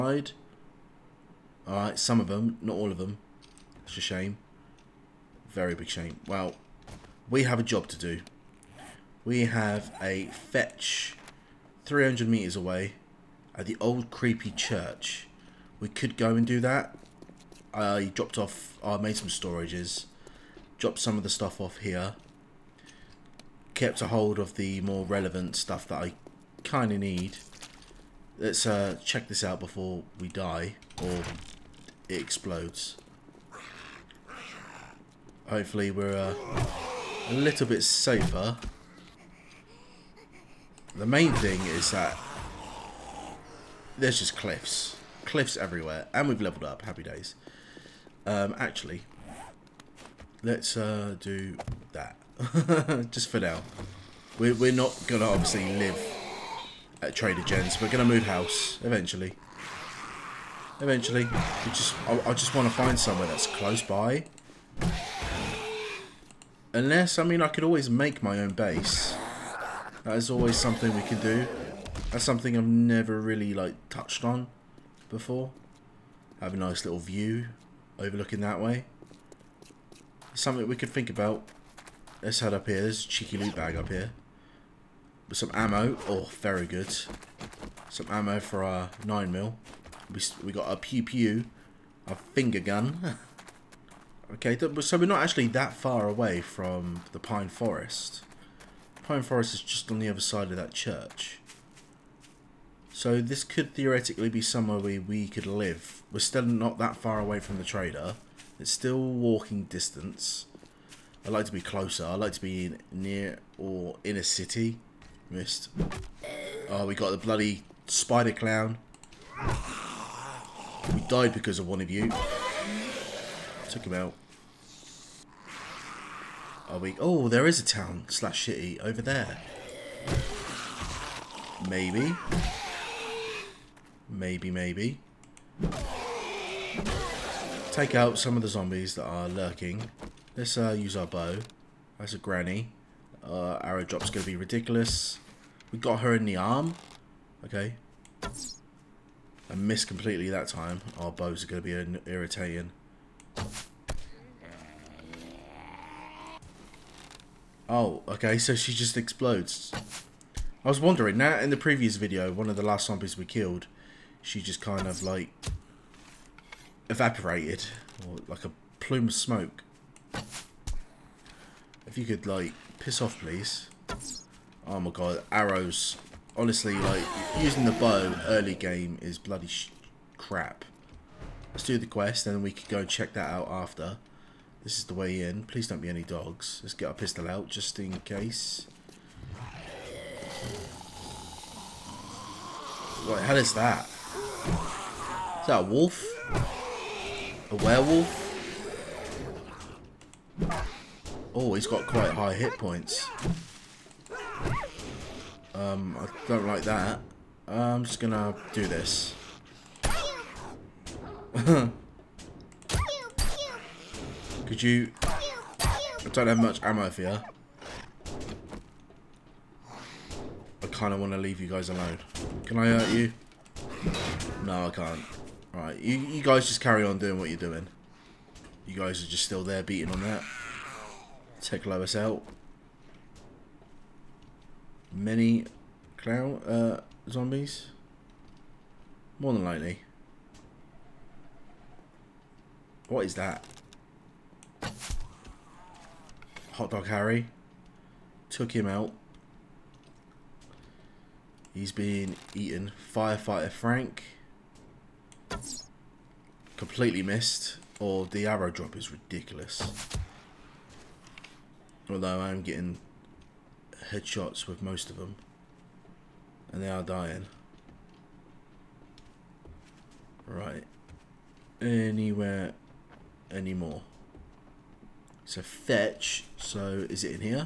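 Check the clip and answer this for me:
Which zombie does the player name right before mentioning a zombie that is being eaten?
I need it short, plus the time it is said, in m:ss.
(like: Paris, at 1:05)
Hot Dog Harry, at 4:06.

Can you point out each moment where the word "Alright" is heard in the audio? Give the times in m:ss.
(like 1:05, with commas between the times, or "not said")
0:01, 3:45.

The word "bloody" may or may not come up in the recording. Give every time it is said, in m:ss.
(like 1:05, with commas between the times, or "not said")
1:57, 2:59.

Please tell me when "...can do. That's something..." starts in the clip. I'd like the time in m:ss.
1:11.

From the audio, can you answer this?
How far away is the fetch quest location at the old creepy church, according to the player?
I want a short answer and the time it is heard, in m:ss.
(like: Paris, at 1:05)
300 metres, at 0:11.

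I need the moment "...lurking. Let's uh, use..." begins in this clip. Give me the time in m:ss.
2:19.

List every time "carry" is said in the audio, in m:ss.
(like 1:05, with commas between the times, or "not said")
3:46.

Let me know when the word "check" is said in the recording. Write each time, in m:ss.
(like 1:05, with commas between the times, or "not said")
0:29, 3:02.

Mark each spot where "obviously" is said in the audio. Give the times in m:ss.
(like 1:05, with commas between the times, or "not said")
0:55.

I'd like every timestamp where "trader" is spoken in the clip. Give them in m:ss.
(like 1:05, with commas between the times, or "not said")
0:57, 1:47.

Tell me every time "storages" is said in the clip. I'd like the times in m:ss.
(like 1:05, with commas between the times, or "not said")
0:19.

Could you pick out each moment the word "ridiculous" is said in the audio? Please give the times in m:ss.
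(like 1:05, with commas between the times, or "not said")
2:24, 4:18.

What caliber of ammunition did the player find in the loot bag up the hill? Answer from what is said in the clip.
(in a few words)
9mm.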